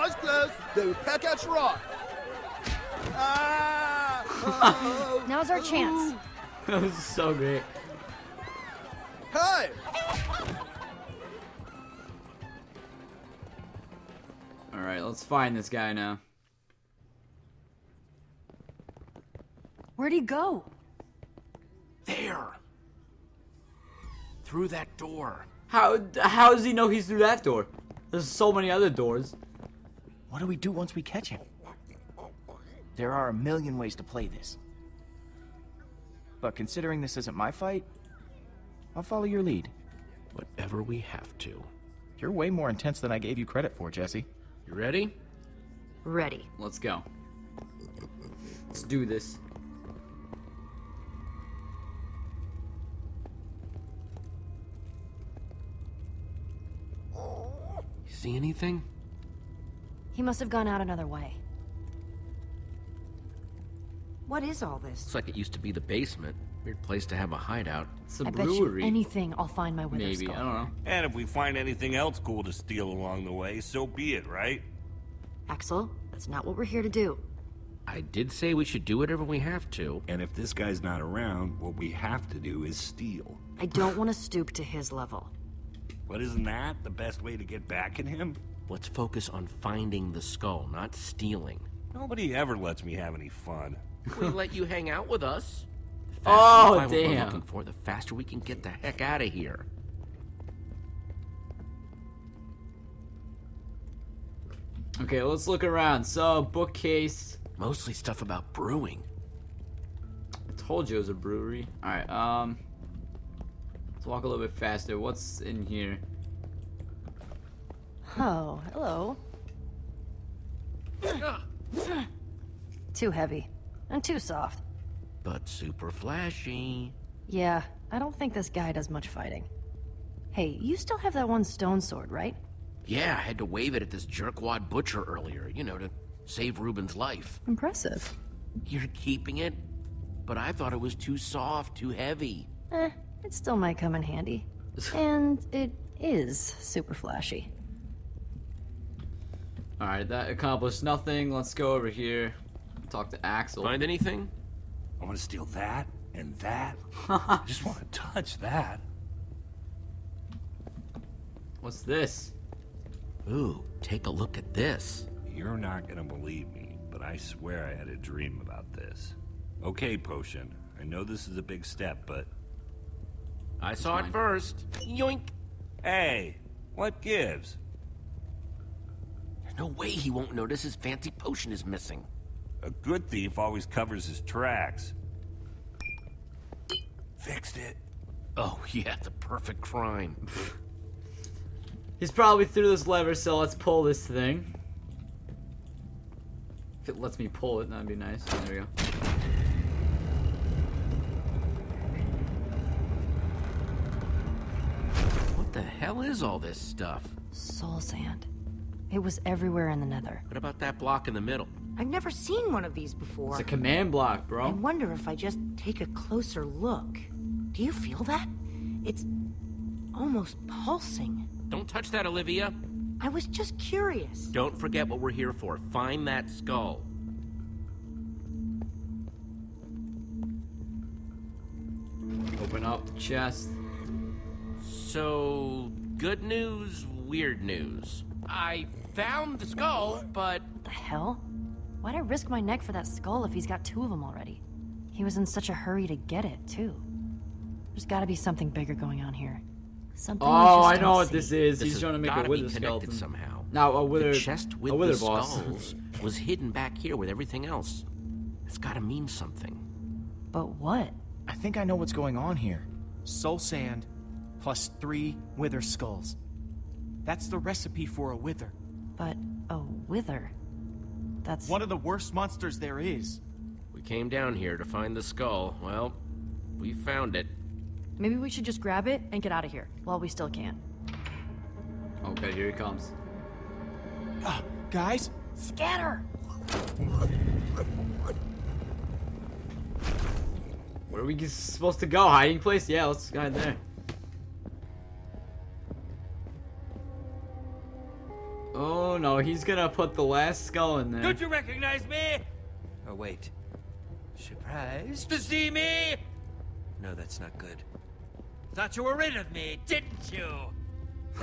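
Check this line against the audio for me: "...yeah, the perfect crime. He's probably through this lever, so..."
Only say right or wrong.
right.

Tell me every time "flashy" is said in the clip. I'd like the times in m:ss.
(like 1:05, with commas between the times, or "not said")
2:05, 2:26.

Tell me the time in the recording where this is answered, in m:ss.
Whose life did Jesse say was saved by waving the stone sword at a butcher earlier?
2:16.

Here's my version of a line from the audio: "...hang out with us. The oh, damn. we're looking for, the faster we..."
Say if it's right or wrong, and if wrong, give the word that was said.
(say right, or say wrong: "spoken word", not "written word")
right.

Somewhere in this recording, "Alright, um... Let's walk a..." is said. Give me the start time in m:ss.
1:51.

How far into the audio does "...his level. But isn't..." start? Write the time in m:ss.
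1:24.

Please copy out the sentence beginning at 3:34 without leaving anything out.
I wonder if I just take a closer look.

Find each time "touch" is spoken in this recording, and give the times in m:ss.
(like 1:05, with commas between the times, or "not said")
2:37, 3:41.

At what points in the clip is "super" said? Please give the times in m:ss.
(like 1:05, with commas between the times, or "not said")
2:05, 2:26.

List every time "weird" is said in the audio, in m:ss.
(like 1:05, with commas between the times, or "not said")
1:06, 3:57.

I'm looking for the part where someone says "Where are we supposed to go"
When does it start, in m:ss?
4:50.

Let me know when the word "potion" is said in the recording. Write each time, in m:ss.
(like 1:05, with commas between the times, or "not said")
2:49, 3:01.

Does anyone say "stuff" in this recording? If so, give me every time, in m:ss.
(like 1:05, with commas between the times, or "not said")
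1:47, 3:26.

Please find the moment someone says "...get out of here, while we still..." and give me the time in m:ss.
4:39.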